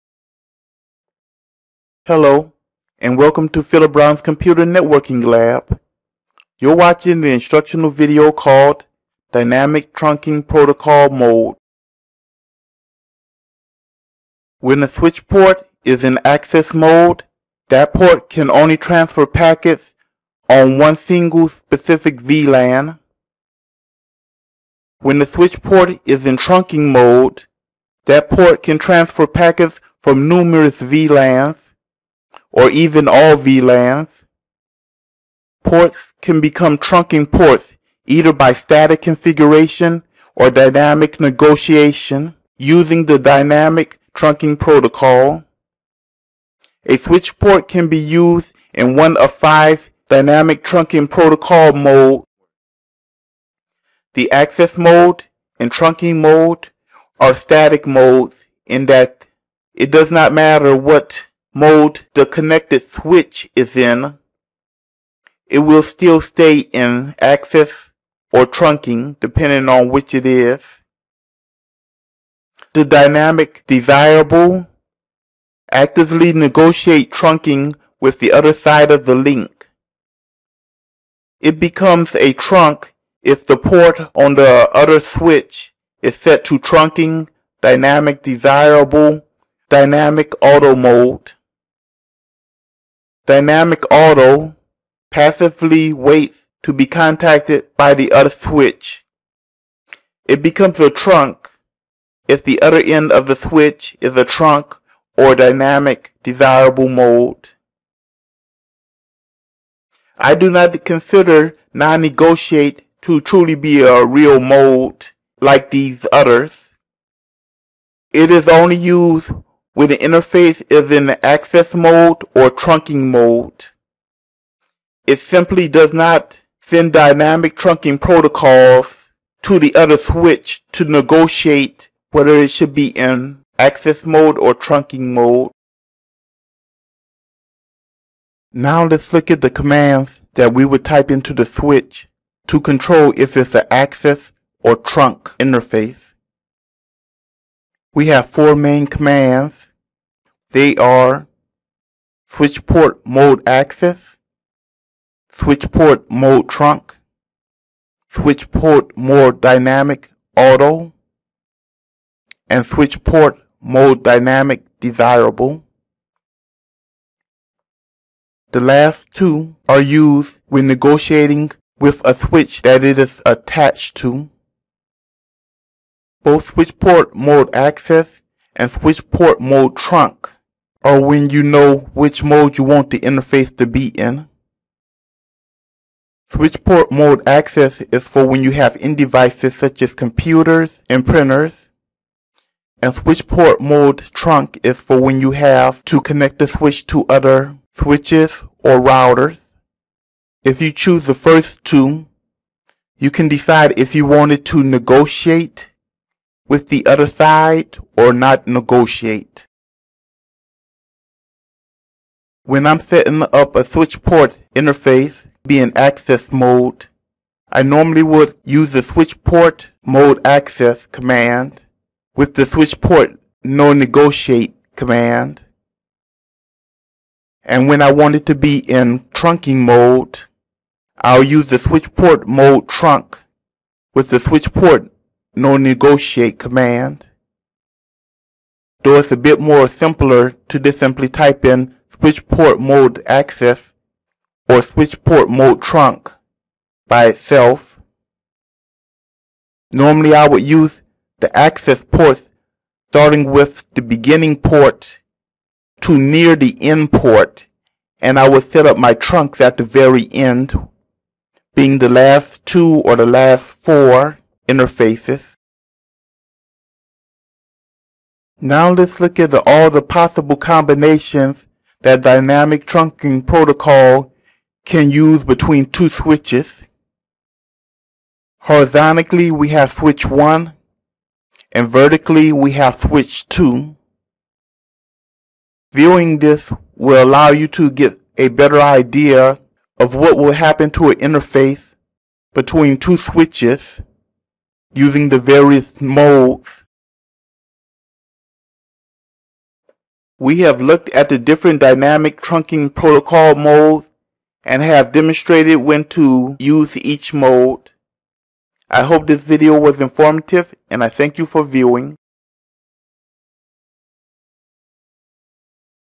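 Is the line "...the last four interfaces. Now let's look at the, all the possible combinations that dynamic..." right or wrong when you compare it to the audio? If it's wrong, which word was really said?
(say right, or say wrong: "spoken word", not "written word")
right.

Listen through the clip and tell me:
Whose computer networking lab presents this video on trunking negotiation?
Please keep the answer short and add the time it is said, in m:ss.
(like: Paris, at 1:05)
Philip Brown, at 0:03.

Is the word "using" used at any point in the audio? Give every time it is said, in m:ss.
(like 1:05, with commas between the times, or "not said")
0:42, 4:54.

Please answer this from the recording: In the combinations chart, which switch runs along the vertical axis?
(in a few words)
switch 2.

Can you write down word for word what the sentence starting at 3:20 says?
If you choose the first two, you can decide if you wanted to negotiate with the other side or not negotiate.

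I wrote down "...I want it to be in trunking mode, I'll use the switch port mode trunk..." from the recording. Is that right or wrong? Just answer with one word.
right.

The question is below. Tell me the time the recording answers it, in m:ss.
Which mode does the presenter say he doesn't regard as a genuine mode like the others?
1:51.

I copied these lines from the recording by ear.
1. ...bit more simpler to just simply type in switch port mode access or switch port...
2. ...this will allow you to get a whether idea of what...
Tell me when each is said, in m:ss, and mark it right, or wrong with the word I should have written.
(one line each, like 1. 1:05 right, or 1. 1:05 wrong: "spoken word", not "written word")
1. 3:59 right
2. 4:46 wrong: "better", not "whether".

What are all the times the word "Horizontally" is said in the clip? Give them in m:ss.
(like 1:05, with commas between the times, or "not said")
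4:38.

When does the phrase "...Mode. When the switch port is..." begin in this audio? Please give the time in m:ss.
0:11.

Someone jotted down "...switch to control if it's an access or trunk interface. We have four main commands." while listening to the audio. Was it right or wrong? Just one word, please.
right.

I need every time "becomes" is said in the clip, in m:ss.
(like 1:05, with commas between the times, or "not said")
0:36, 1:21, 1:40.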